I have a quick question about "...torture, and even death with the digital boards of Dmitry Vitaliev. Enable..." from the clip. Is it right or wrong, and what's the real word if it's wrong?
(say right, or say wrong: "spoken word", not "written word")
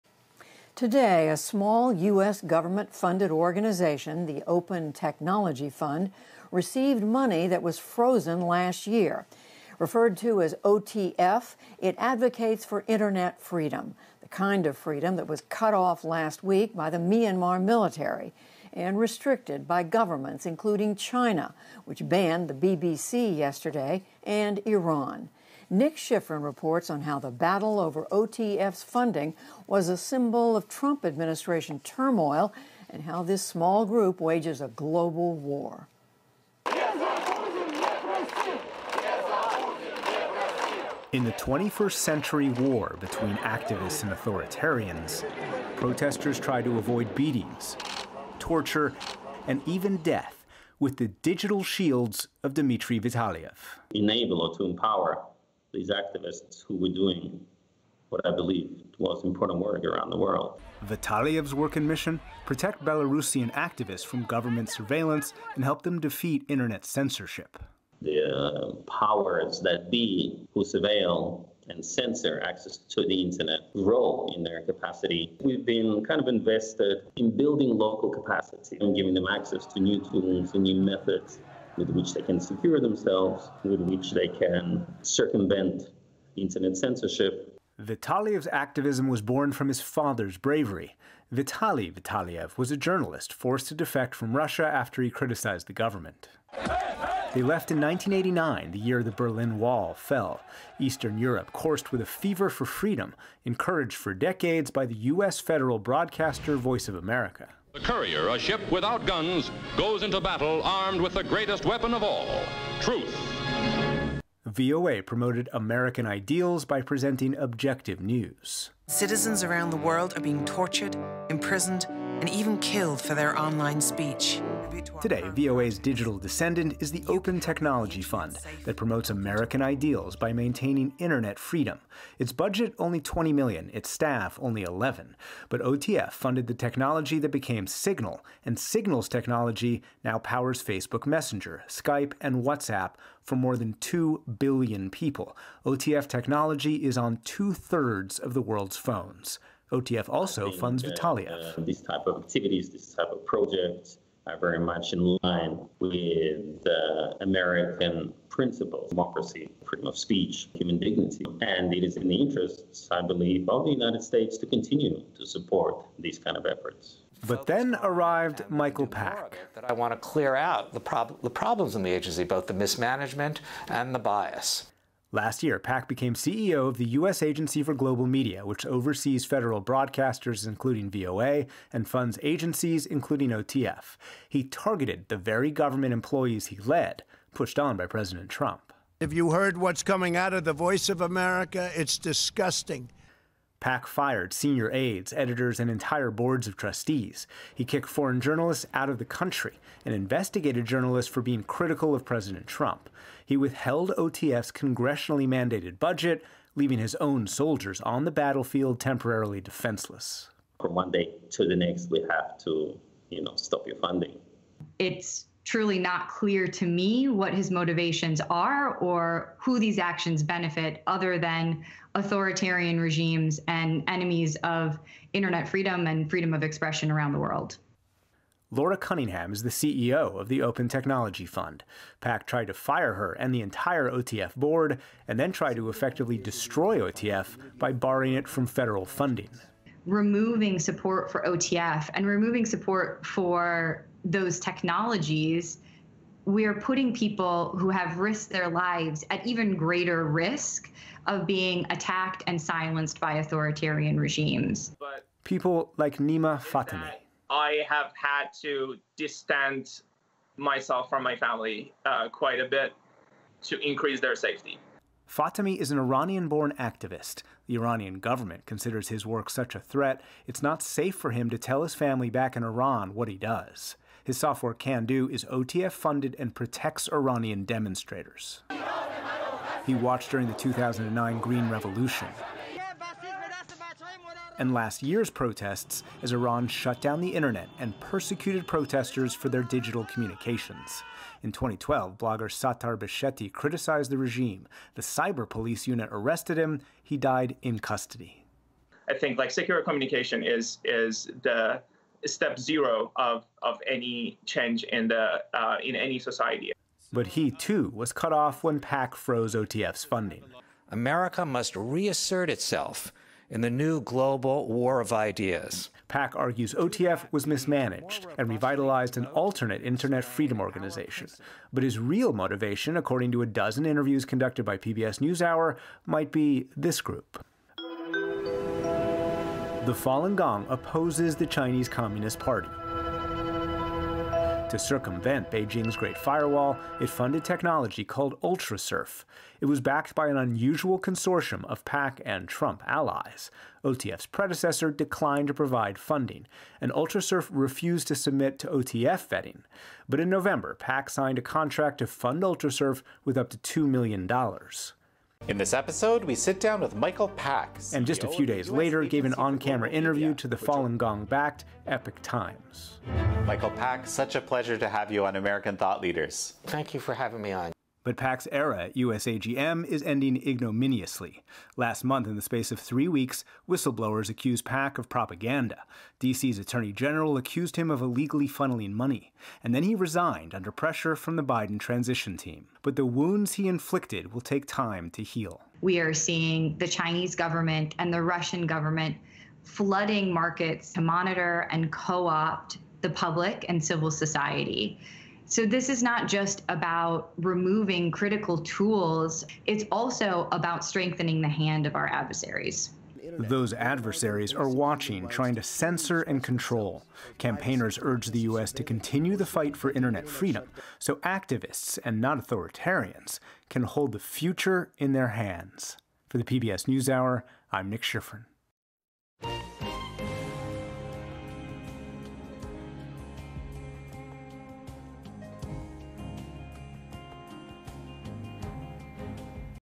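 wrong: "shields", not "boards".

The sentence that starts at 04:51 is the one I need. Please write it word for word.
In 2012, blogger Sattar Beheshti criticized the regime.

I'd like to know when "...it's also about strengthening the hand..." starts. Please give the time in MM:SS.
06:39.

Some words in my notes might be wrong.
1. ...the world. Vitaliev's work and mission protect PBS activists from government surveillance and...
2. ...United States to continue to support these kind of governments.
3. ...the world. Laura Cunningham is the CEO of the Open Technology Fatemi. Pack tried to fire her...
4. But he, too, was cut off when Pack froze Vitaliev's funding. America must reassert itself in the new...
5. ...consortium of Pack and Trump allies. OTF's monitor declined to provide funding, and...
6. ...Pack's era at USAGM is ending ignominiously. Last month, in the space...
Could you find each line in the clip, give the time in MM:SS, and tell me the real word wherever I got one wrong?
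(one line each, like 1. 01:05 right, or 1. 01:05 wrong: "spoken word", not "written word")
1. 01:00 wrong: "Belarusian", not "PBS"
2. 02:43 wrong: "efforts", not "governments"
3. 03:47 wrong: "Fund", not "Fatemi"
4. 05:06 wrong: "OTF", not "Vitaliev"
5. 05:40 wrong: "predecessor", not "monitor"
6. 06:07 right.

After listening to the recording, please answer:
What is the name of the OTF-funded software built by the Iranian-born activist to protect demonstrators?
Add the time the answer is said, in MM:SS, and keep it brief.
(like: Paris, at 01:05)
Kandoo, at 04:34.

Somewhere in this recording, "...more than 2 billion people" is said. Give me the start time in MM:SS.
02:23.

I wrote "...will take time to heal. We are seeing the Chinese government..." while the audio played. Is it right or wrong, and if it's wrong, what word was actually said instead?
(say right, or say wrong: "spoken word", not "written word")
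right.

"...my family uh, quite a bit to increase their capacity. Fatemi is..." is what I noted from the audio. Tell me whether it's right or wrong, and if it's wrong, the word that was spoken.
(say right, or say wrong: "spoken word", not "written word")
wrong: "safety", not "capacity".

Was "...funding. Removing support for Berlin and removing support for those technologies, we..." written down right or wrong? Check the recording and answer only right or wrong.
wrong.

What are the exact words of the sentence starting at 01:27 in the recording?
Vitaliev's activism was born from his father's bravery.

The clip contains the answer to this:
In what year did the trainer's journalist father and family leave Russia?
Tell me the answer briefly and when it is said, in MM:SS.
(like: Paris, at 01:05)
1989, at 01:37.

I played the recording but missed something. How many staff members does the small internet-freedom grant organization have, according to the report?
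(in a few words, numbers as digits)
11.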